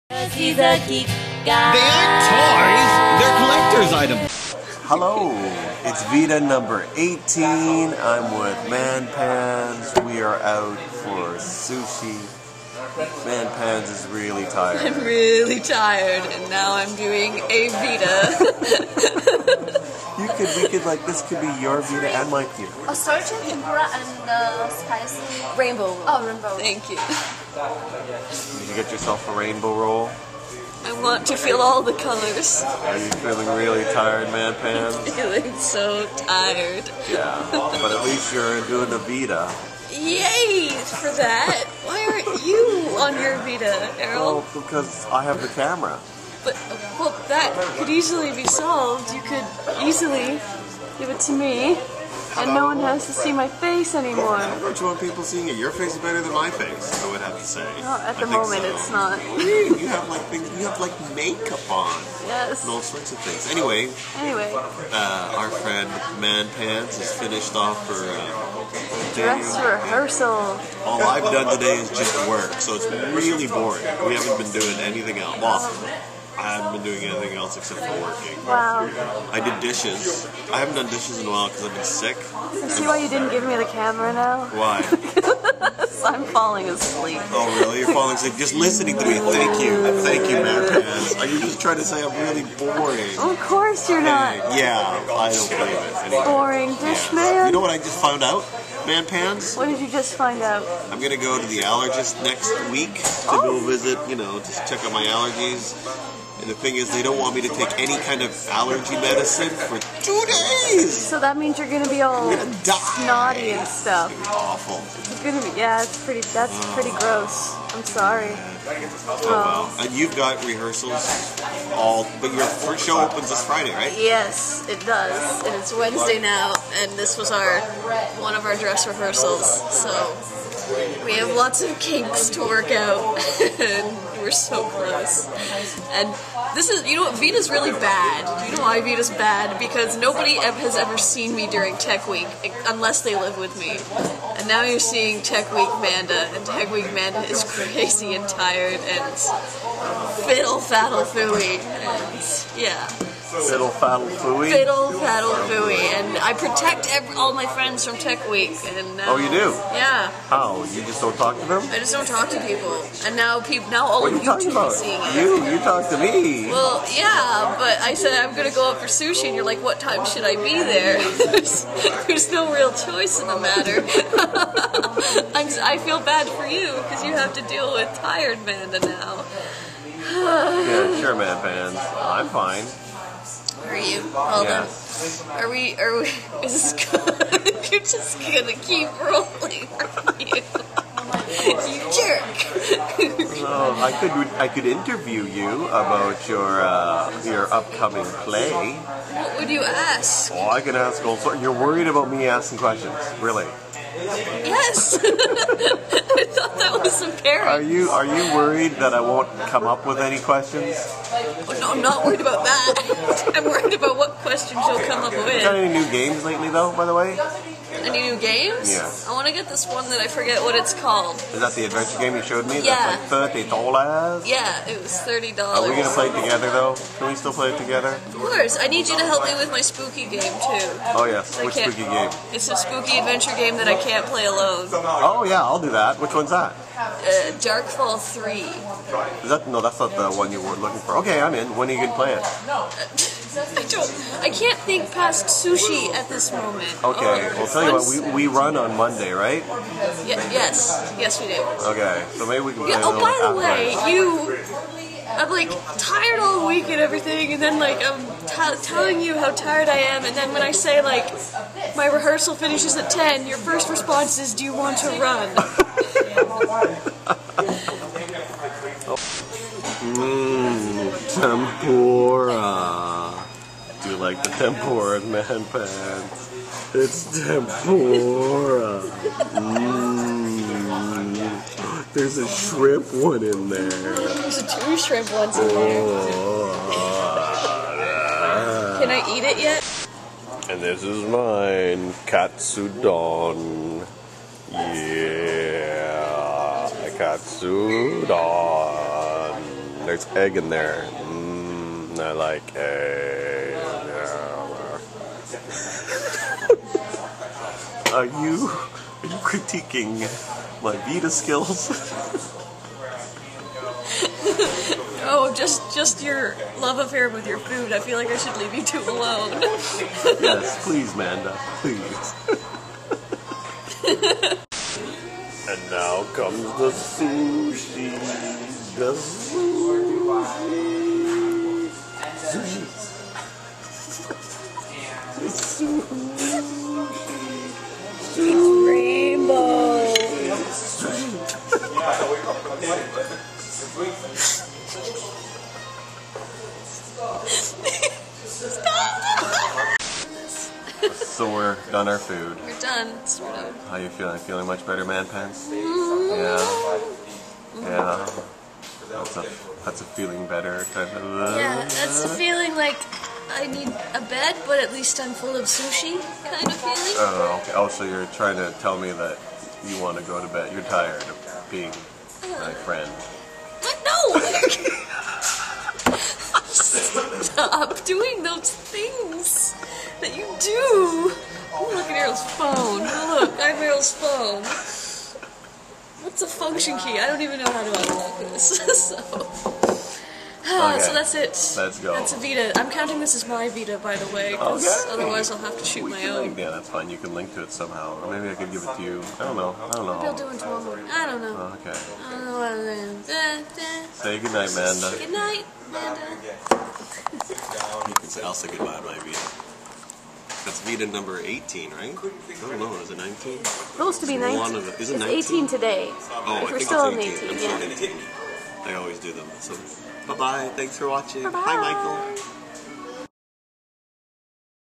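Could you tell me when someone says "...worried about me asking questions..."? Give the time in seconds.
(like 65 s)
201 s.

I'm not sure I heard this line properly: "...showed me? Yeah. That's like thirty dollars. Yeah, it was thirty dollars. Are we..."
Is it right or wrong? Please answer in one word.
right.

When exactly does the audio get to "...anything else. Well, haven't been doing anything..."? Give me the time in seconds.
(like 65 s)
74 s.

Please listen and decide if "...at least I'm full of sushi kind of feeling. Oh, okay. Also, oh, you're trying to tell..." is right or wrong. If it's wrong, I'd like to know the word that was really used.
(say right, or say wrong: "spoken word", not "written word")
right.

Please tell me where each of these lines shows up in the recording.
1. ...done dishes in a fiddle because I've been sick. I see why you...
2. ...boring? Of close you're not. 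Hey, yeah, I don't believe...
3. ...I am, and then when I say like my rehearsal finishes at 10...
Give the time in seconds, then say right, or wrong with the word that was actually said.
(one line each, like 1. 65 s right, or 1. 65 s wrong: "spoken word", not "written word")
1. 80 s wrong: "while", not "fiddle"
2. 92 s wrong: "course", not "close"
3. 259 s right.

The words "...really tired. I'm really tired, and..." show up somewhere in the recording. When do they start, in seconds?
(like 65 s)
14 s.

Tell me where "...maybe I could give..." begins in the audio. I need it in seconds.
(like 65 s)
398 s.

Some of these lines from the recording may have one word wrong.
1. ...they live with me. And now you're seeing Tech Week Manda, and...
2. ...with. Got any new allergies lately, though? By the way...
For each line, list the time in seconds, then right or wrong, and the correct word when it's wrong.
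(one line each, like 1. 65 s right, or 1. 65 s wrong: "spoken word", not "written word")
1. 143 s right
2. 215 s wrong: "games", not "allergies".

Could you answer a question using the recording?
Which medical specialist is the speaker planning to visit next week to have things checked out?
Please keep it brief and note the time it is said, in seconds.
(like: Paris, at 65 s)
Allergist, at 101 s.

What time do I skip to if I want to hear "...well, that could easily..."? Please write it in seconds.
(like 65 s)
46 s.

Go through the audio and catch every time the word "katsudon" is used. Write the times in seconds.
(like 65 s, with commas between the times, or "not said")
292 s, 297 s.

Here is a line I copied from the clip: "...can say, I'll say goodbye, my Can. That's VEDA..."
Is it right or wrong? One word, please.
wrong.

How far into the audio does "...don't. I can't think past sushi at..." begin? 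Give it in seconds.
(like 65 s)
243 s.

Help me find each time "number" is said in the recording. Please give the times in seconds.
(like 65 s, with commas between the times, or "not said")
6 s, 410 s.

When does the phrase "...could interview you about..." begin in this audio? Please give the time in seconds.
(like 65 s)
194 s.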